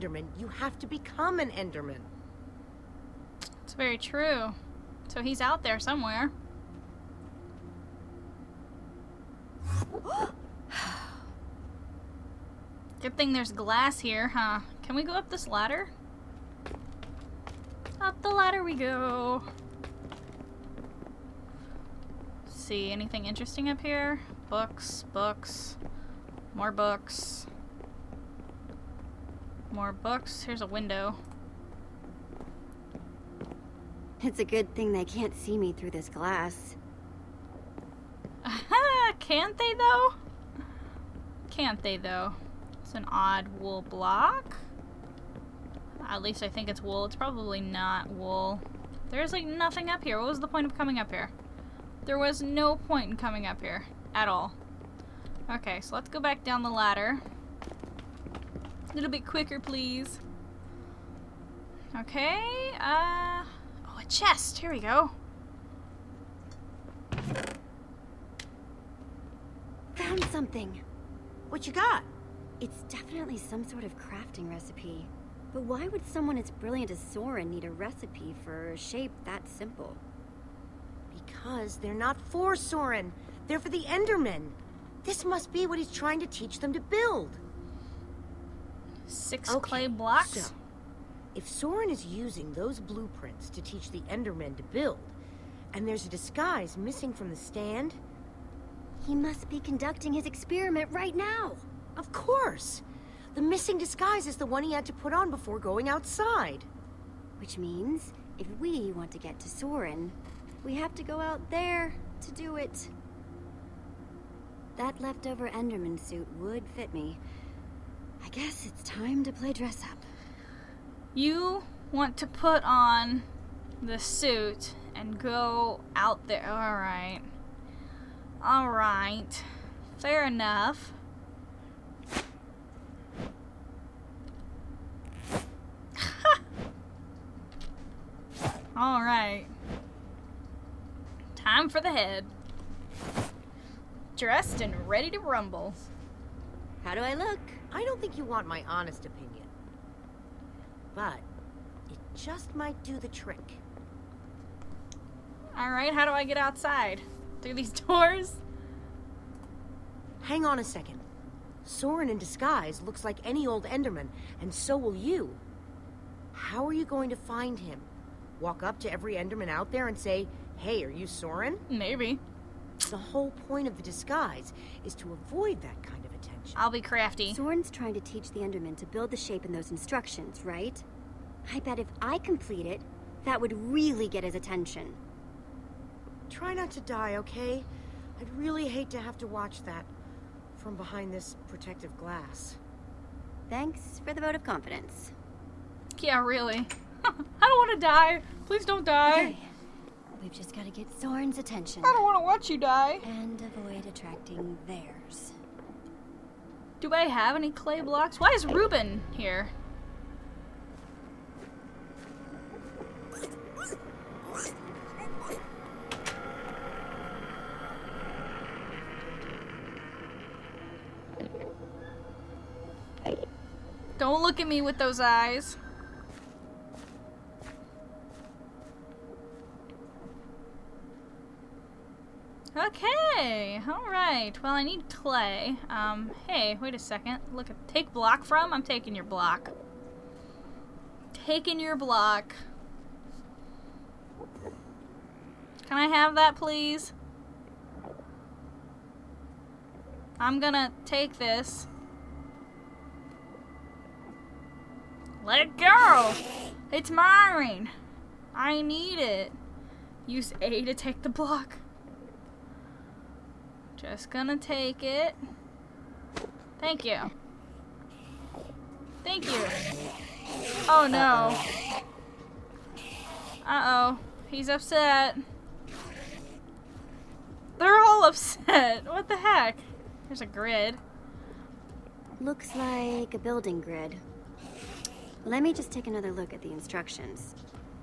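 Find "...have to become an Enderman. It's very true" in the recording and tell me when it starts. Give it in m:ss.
0:00.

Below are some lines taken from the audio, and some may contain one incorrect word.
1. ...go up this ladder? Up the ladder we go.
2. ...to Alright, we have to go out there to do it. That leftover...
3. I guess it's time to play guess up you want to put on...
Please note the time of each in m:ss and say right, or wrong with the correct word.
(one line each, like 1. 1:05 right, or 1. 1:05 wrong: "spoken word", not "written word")
1. 0:15 right
2. 1:49 wrong: "Soren", not "Alright"
3. 1:58 wrong: "dress", not "guess".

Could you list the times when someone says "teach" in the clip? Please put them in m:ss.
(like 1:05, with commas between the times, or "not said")
1:26, 1:33, 2:57.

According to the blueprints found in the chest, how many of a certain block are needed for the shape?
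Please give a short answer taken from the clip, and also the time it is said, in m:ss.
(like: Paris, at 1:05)
6, at 1:29.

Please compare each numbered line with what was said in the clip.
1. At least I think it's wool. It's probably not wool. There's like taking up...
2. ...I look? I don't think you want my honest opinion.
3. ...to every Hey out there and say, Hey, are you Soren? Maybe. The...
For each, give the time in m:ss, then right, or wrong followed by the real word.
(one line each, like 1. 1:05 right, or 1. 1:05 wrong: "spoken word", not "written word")
1. 0:46 wrong: "nothing", not "taking"
2. 2:27 right
3. 2:48 wrong: "Enderman", not "Hey".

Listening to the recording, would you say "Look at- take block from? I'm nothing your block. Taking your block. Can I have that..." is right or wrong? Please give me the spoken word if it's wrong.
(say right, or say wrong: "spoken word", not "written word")
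wrong: "taking", not "nothing".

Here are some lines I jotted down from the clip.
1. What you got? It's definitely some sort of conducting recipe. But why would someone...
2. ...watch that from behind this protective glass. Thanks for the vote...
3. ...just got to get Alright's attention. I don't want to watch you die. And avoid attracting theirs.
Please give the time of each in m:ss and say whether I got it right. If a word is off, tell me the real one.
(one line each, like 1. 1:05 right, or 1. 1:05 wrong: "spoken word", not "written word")
1. 1:11 wrong: "crafting", not "conducting"
2. 3:09 right
3. 3:20 wrong: "Soren", not "Alright".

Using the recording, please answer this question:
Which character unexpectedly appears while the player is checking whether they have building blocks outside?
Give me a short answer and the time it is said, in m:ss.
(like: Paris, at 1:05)
Reuben, at 3:28.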